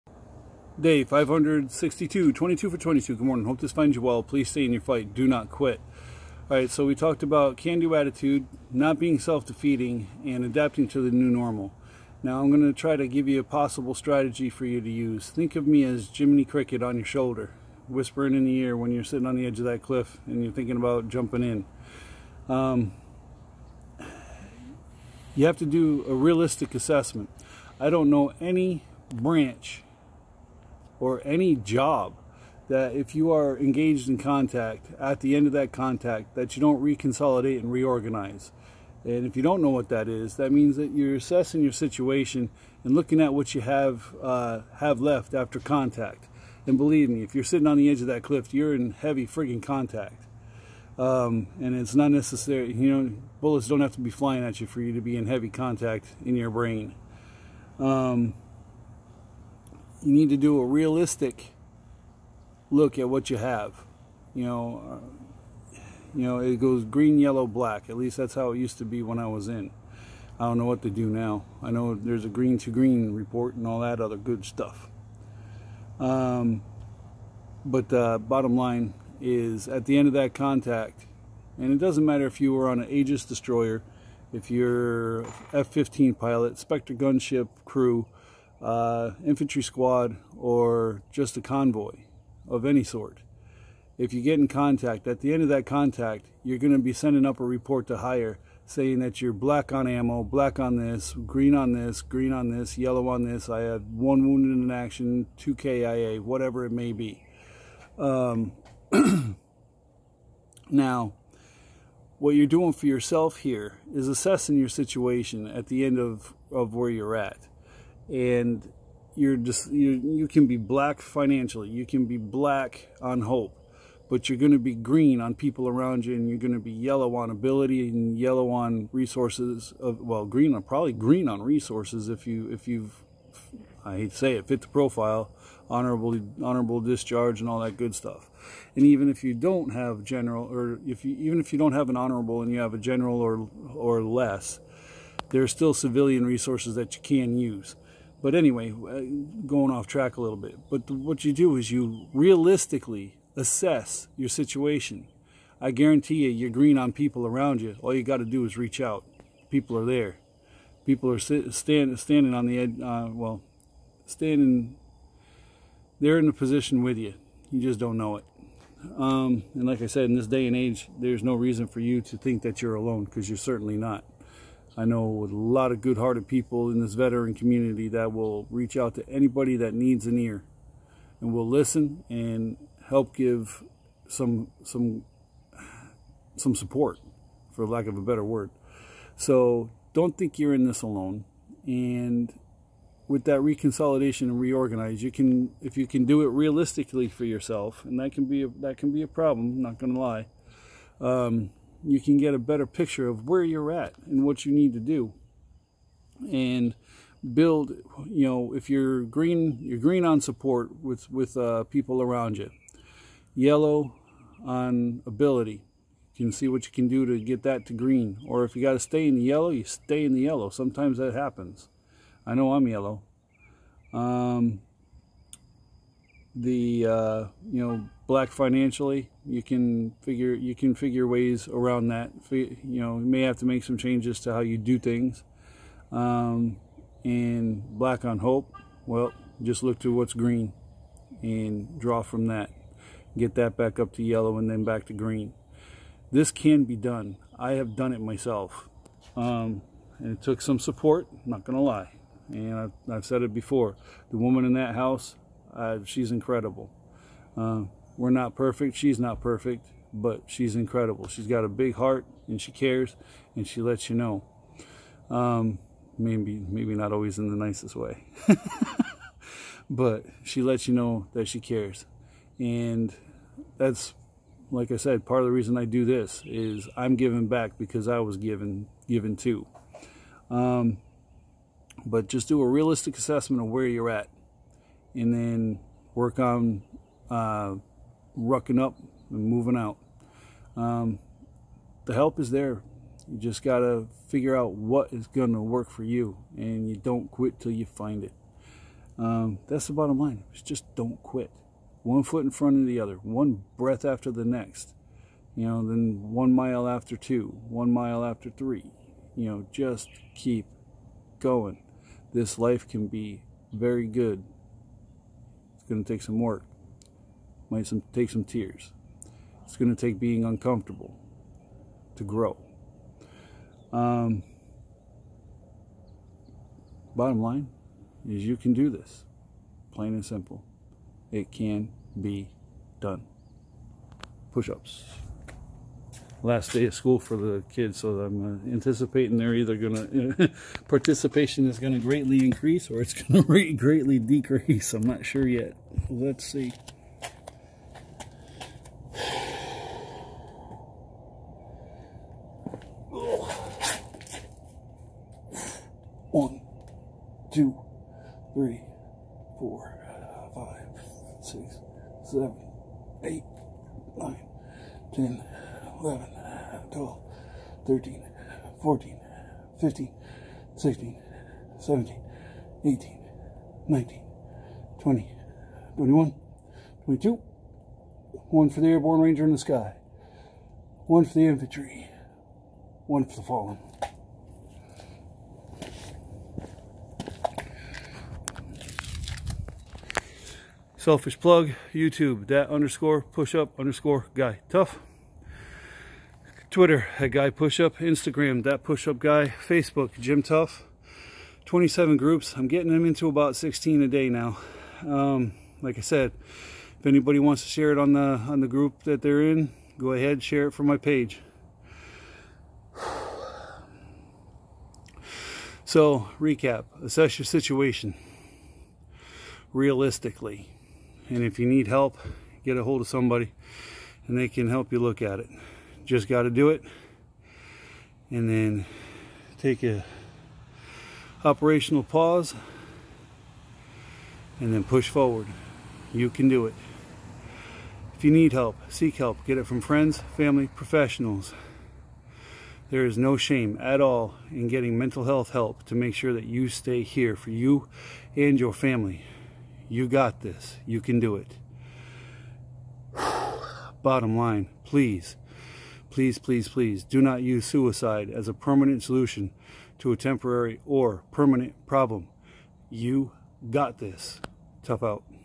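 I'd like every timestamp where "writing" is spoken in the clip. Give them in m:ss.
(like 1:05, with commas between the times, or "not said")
not said.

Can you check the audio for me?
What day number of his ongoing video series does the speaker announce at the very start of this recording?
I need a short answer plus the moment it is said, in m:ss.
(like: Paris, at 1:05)
562, at 0:00.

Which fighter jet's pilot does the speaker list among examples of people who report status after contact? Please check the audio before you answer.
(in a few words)
F-15.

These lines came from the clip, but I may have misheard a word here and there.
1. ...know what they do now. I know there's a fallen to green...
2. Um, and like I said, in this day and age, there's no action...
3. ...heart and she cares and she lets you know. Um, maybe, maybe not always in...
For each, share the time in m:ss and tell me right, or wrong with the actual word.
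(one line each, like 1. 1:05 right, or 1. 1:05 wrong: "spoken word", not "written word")
1. 1:10 wrong: "green", not "fallen"
2. 2:48 wrong: "reason", not "action"
3. 4:21 right.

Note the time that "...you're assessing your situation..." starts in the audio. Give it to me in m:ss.
0:40.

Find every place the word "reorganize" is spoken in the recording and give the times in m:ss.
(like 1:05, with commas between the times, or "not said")
0:37, 3:14.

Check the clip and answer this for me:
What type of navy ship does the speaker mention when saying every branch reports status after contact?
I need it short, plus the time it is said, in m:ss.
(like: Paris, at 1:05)
Aegis destroyer, at 1:22.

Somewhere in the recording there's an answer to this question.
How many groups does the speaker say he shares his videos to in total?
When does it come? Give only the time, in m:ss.
6:41.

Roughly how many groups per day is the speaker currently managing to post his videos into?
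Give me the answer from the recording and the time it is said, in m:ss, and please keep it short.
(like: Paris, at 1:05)
16, at 6:43.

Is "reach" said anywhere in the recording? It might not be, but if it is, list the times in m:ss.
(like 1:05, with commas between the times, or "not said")
2:38, 2:58.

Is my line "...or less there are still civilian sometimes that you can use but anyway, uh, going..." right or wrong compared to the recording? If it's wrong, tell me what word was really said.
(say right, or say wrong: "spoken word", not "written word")
wrong: "resources", not "sometimes".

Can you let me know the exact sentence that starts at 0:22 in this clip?
Um, you have to do a realistic assessment.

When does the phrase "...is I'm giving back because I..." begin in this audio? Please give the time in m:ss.
4:36.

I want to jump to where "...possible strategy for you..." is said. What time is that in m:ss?
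0:13.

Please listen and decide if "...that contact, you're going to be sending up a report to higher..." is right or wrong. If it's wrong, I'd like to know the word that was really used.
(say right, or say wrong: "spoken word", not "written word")
right.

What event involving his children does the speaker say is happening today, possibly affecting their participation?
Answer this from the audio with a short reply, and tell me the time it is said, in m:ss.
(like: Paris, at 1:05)
Last day of school, at 5:36.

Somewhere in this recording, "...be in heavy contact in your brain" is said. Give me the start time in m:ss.
0:55.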